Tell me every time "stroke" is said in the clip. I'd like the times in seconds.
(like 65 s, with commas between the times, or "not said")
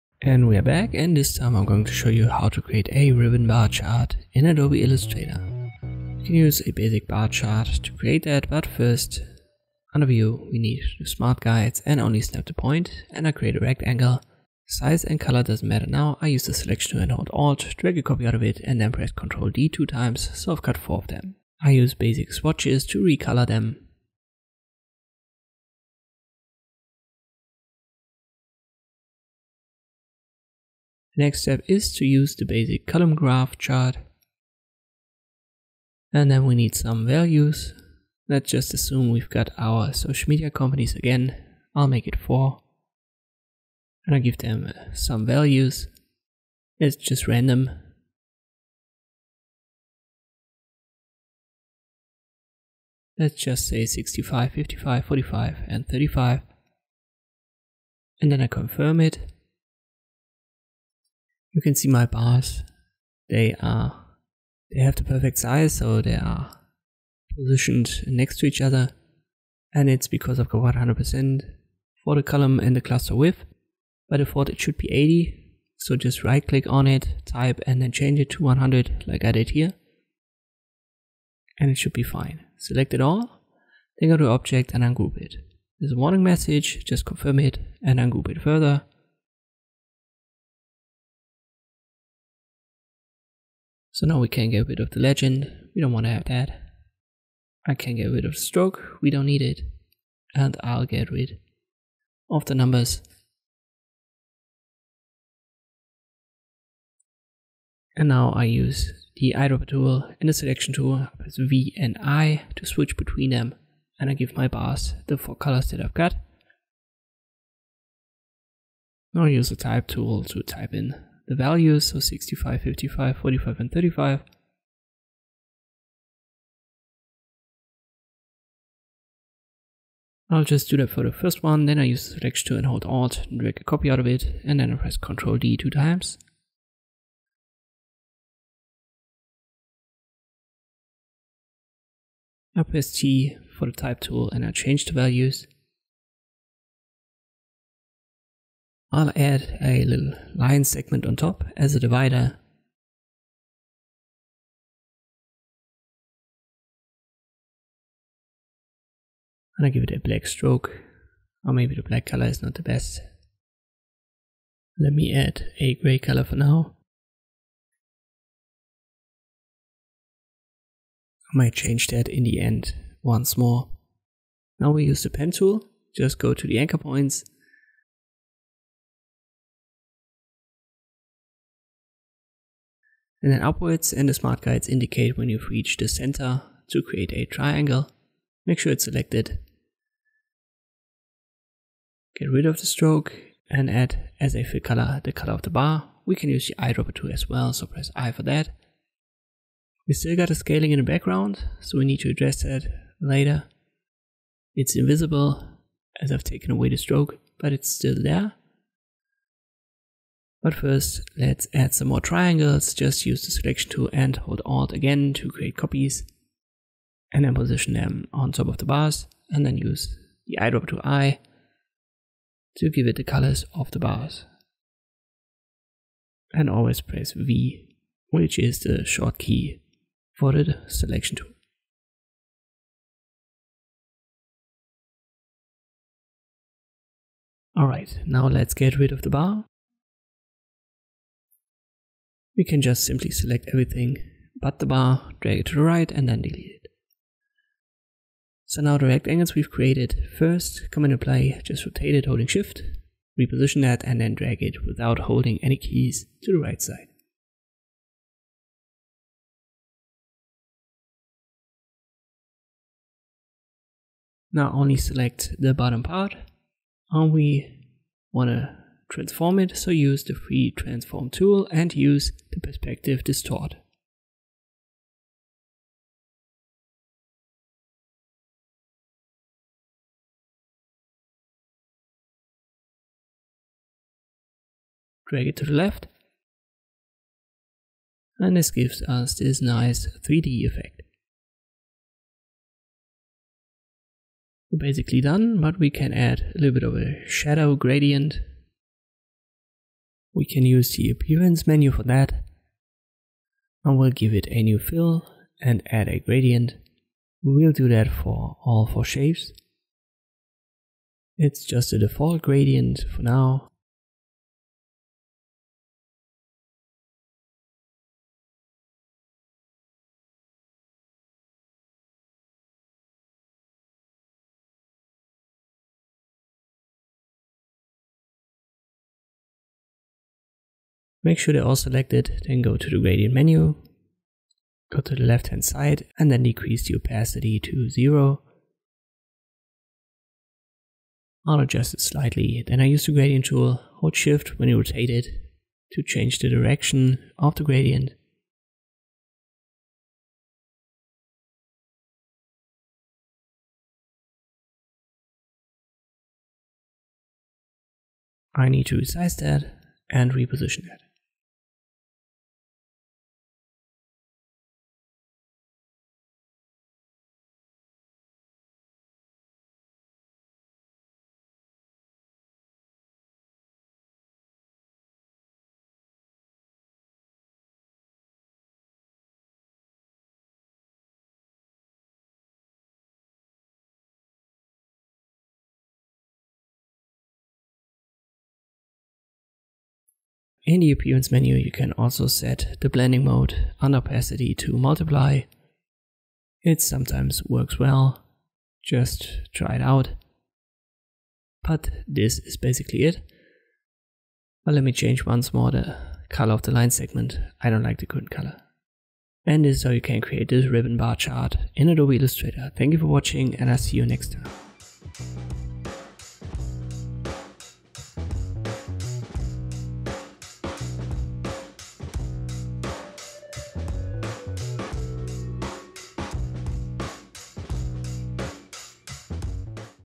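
98 s, 160 s, 192 s, 206 s.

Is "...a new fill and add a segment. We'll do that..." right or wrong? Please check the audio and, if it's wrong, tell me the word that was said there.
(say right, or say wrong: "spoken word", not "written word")
wrong: "gradient", not "segment".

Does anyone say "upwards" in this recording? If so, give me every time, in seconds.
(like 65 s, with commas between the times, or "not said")
183 s.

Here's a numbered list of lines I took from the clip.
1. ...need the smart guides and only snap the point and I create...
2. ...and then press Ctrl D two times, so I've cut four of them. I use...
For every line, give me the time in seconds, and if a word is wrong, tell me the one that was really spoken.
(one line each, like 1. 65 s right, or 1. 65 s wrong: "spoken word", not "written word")
1. 10 s right
2. 18 s right.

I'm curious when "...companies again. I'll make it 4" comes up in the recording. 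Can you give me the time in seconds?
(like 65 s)
40 s.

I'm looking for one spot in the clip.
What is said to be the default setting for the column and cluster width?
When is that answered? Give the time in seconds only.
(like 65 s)
74 s.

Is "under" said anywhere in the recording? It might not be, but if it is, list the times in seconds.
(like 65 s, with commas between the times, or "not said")
9 s.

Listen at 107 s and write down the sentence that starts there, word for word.
And now I use the eyedropper tool and the selection tool, as V and I to switch between them.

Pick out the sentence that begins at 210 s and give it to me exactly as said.
But first, let's add some more triangles.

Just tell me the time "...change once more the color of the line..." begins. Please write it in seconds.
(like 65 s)
404 s.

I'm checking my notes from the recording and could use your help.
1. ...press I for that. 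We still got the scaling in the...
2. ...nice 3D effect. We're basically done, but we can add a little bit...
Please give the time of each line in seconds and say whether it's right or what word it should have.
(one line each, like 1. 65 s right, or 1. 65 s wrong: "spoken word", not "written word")
1. 197 s right
2. 289 s right.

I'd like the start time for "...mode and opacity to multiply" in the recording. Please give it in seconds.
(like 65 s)
393 s.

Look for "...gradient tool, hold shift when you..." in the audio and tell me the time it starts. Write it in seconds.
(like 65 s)
342 s.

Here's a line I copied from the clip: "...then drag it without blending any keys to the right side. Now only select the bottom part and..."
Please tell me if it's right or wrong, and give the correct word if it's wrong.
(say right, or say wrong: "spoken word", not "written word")
wrong: "holding", not "blending".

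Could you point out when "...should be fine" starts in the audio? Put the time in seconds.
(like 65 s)
81 s.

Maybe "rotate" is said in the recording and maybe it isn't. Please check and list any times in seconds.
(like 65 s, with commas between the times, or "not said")
251 s, 344 s.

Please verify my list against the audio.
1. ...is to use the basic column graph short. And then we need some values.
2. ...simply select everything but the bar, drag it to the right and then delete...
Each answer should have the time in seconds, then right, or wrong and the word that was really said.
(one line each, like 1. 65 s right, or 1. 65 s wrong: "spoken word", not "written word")
1. 31 s wrong: "chart", not "short"
2. 242 s right.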